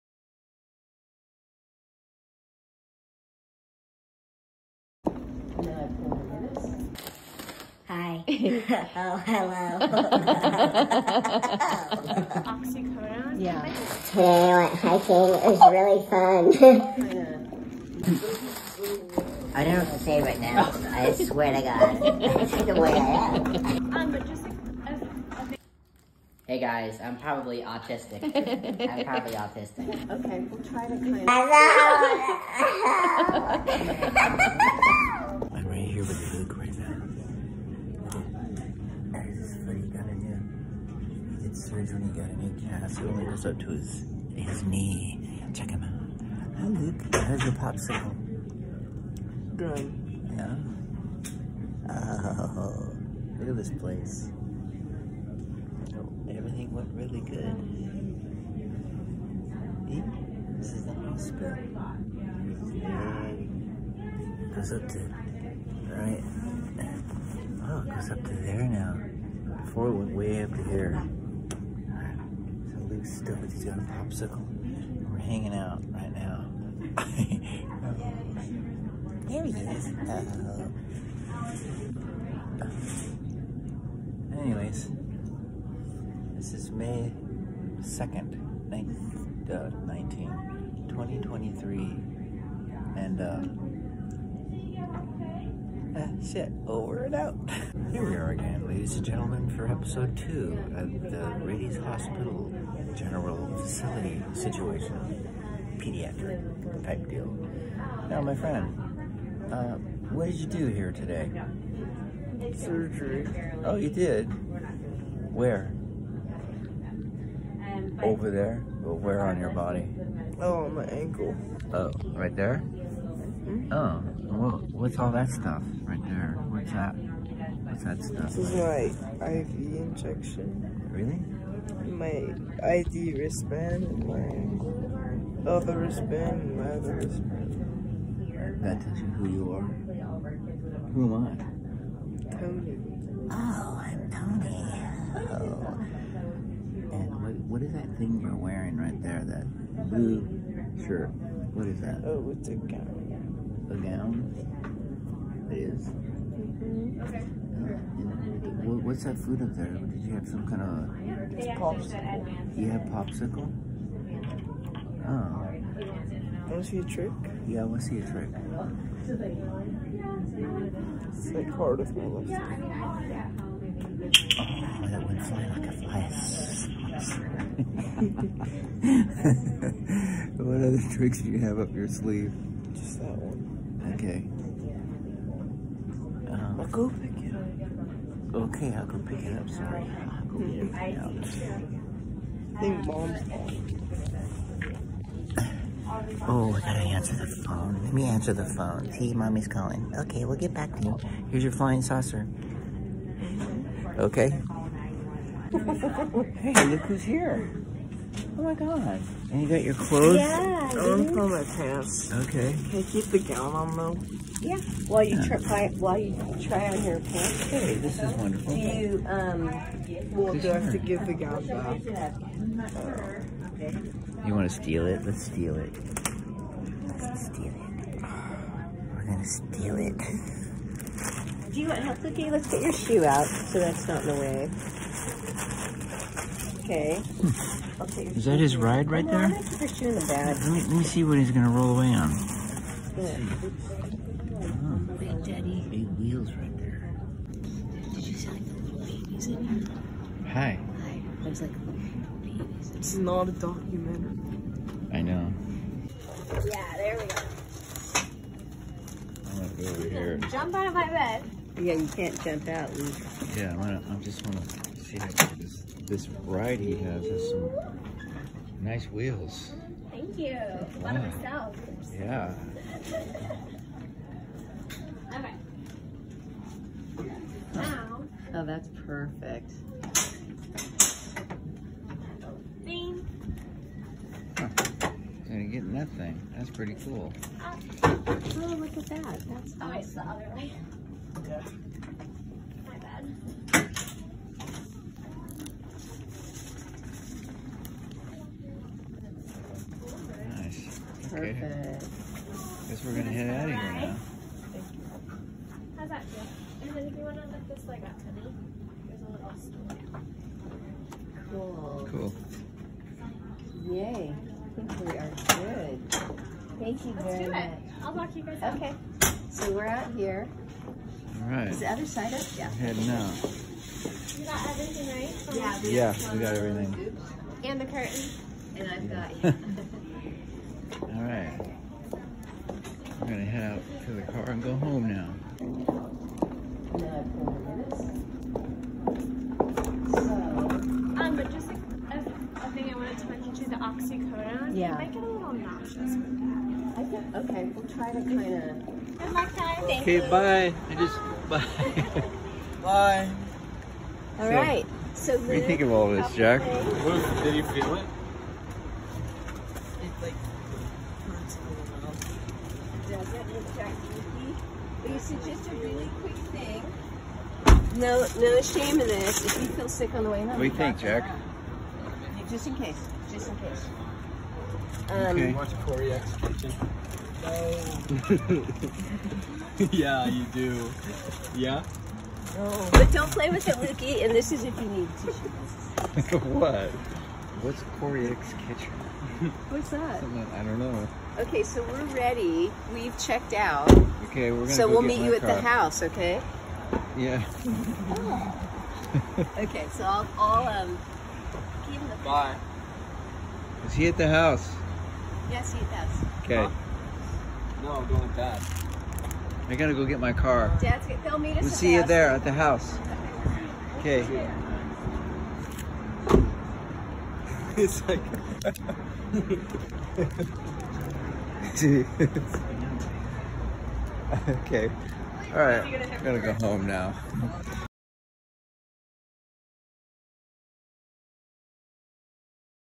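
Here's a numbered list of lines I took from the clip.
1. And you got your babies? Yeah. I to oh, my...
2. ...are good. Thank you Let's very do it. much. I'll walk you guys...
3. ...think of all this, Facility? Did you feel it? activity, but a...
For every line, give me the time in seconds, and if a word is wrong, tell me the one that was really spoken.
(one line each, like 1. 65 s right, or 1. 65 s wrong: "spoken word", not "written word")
1. 209 s wrong: "clothes", not "babies"
2. 314 s right
3. 355 s wrong: "Jack", not "Facility".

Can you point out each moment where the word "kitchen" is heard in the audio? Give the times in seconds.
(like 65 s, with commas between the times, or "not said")
376 s, 388 s.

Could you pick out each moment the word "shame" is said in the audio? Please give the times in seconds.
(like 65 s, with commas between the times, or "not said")
368 s.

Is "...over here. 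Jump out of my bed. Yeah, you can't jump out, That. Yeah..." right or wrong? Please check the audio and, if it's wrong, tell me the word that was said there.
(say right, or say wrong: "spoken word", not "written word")
wrong: "Luke", not "That".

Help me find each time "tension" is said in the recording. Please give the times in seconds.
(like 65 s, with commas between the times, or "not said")
not said.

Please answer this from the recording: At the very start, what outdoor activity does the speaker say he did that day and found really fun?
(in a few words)
Hiking.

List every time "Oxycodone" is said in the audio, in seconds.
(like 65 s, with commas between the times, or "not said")
12 s.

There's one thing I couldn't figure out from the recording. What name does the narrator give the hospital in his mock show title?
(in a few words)
Rady's.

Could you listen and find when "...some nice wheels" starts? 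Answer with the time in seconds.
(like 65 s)
267 s.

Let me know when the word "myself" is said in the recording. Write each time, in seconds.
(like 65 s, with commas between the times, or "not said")
270 s.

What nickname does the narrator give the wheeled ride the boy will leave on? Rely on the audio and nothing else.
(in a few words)
Big Daddy.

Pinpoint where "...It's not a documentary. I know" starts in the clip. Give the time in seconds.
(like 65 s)
252 s.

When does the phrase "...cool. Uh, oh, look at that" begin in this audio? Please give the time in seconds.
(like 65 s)
286 s.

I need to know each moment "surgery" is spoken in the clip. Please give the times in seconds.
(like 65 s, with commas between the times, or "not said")
41 s, 112 s.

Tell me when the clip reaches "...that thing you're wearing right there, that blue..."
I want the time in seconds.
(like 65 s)
147 s.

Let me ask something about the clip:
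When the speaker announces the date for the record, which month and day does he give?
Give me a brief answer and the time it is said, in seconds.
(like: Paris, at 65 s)
May 2nd, at 86 s.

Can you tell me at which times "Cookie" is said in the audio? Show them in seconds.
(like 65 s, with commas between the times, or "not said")
232 s.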